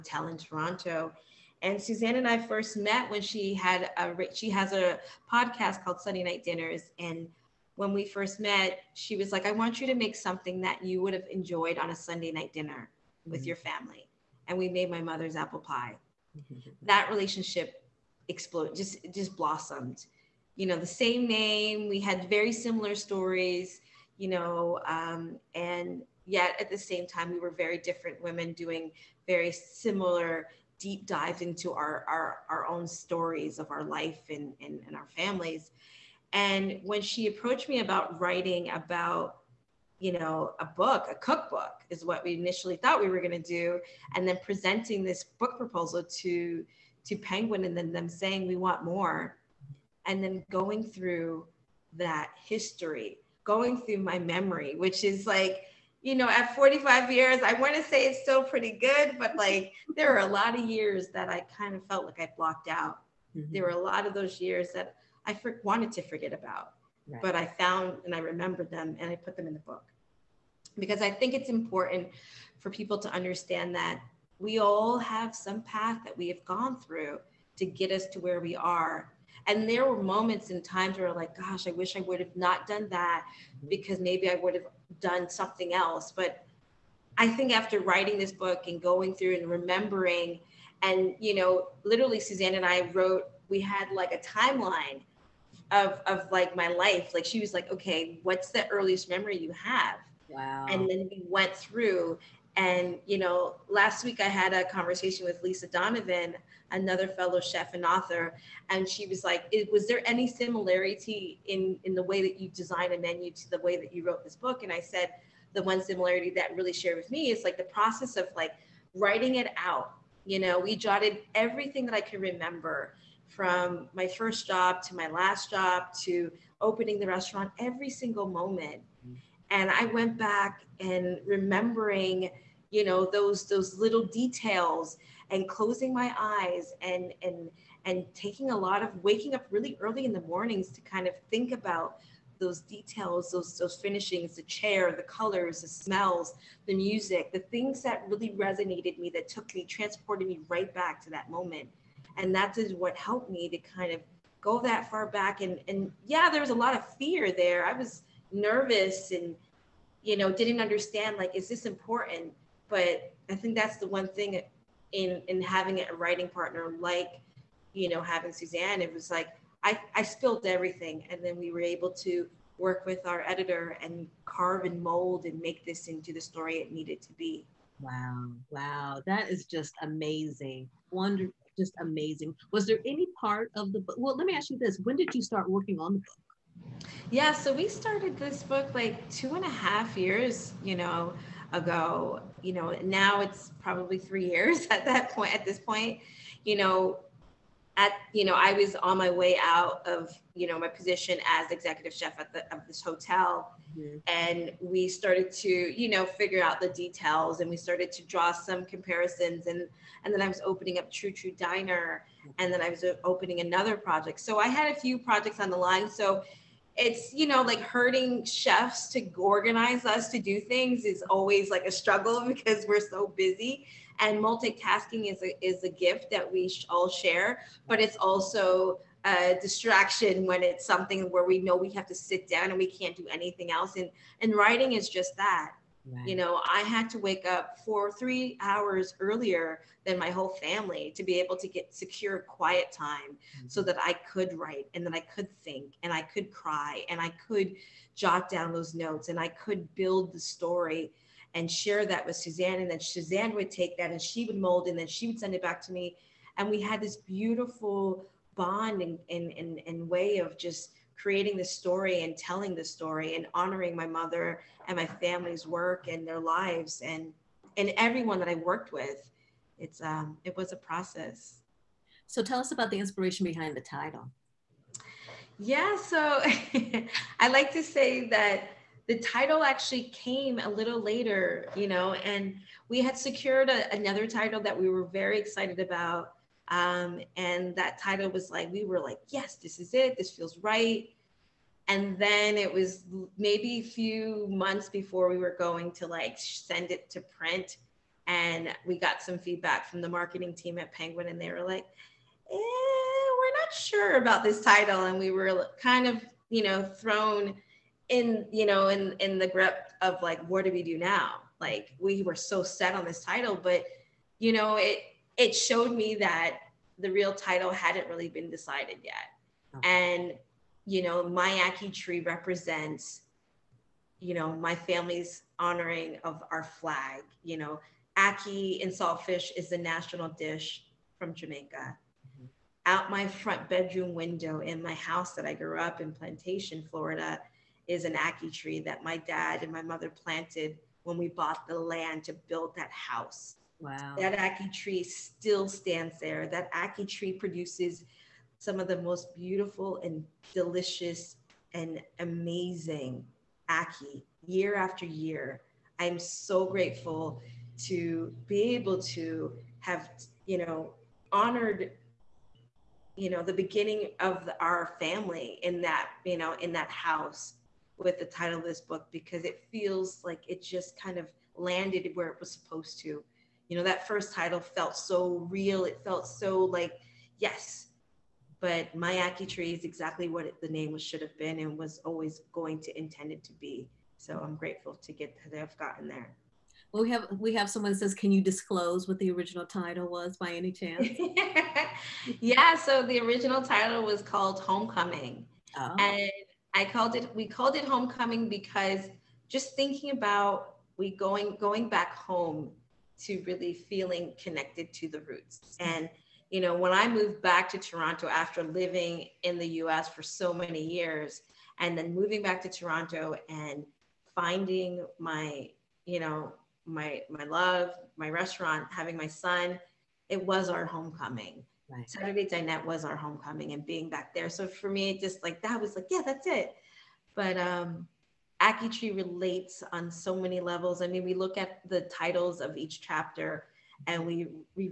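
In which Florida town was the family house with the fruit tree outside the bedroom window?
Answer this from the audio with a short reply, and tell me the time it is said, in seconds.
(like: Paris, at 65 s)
Plantation, at 335 s.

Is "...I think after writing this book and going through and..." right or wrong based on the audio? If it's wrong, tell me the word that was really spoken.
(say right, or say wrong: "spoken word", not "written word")
right.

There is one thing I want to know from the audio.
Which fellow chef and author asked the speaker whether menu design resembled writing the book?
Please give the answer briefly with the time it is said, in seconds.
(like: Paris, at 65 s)
Lisa Donovan, at 105 s.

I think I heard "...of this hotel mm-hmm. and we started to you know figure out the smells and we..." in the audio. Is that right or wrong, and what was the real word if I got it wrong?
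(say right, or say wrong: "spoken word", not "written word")
wrong: "details", not "smells".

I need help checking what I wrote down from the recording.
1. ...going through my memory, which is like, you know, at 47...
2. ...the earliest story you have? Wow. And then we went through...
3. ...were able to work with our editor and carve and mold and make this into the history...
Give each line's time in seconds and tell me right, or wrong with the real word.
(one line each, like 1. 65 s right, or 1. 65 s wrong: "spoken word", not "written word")
1. 53 s wrong: "45", not "47"
2. 98 s wrong: "memory", not "story"
3. 171 s wrong: "story", not "history".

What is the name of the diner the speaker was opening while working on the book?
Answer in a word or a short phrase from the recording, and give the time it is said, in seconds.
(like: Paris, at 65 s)
True True Diner, at 210 s.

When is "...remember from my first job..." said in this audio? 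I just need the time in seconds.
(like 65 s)
122 s.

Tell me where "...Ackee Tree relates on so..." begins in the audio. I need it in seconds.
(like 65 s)
428 s.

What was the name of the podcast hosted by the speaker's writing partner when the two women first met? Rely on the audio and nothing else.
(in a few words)
Sunday Night Dinners.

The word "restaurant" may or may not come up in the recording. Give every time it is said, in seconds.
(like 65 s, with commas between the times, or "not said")
127 s, 418 s.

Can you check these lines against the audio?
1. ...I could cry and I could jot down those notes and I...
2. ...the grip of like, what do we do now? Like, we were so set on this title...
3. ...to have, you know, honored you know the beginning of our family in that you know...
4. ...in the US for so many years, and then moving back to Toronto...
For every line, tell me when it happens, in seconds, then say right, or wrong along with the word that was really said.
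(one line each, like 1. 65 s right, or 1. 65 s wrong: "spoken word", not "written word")
1. 245 s right
2. 309 s right
3. 358 s right
4. 409 s right.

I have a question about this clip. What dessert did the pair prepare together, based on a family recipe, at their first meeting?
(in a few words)
Apple pie.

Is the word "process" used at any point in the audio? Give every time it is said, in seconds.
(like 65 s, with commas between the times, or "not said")
117 s, 270 s.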